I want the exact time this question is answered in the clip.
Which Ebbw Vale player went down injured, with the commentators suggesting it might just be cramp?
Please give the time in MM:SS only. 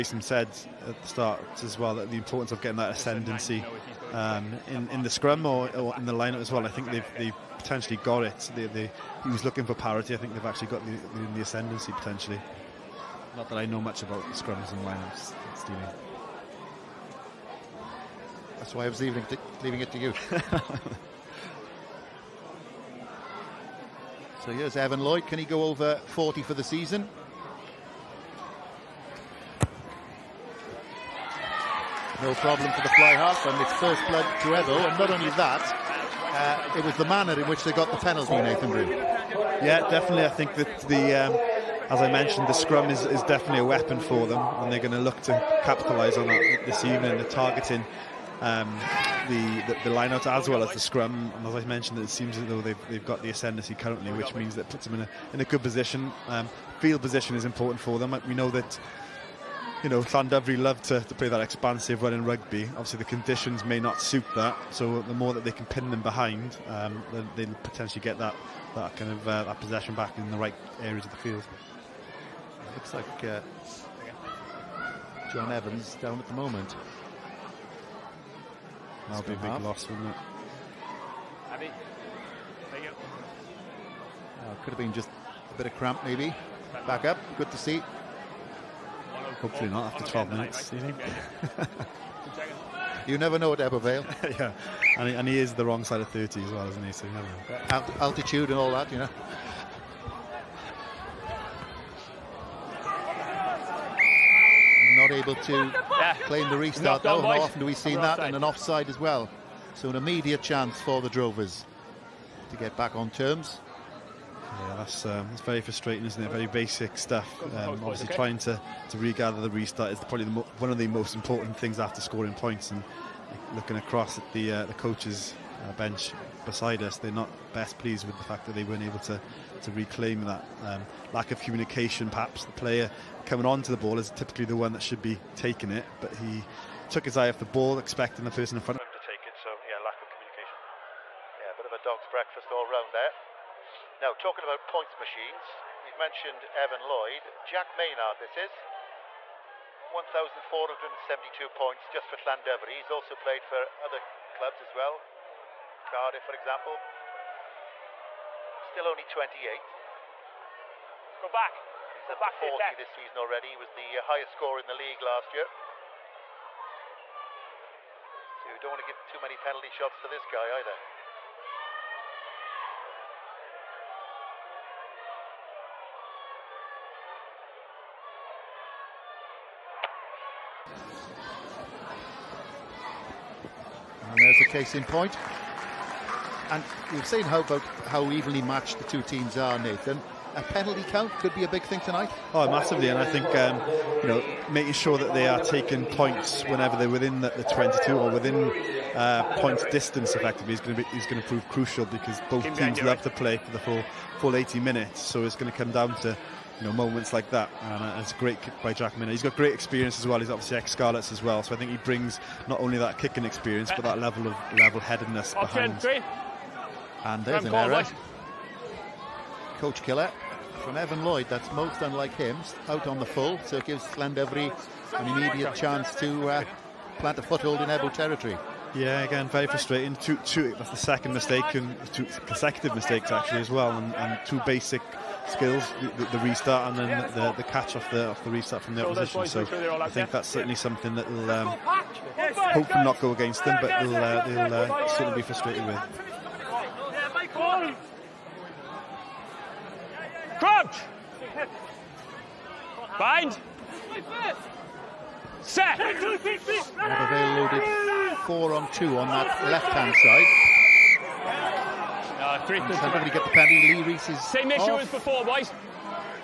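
01:15.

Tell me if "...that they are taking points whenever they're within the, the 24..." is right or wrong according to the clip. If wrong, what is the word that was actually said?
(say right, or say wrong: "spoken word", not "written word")
wrong: "22", not "24".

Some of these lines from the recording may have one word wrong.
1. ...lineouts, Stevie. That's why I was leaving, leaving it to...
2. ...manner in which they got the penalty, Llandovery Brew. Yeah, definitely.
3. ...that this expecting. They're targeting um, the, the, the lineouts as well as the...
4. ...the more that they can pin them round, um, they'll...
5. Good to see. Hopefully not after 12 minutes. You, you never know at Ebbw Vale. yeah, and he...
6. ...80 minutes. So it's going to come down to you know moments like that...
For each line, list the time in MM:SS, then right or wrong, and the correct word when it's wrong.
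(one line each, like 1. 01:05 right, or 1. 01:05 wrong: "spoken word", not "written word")
1. 00:14 right
2. 00:37 wrong: "Nathan", not "Llandovery"
3. 00:46 wrong: "evening", not "expecting"
4. 01:05 wrong: "behind", not "round"
5. 01:27 right
6. 03:24 right.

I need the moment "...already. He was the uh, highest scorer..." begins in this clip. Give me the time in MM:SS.
02:43.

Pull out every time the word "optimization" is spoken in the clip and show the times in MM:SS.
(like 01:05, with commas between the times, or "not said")
not said.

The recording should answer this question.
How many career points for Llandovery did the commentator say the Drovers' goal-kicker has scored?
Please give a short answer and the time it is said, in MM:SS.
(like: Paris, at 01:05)
1,472, at 02:29.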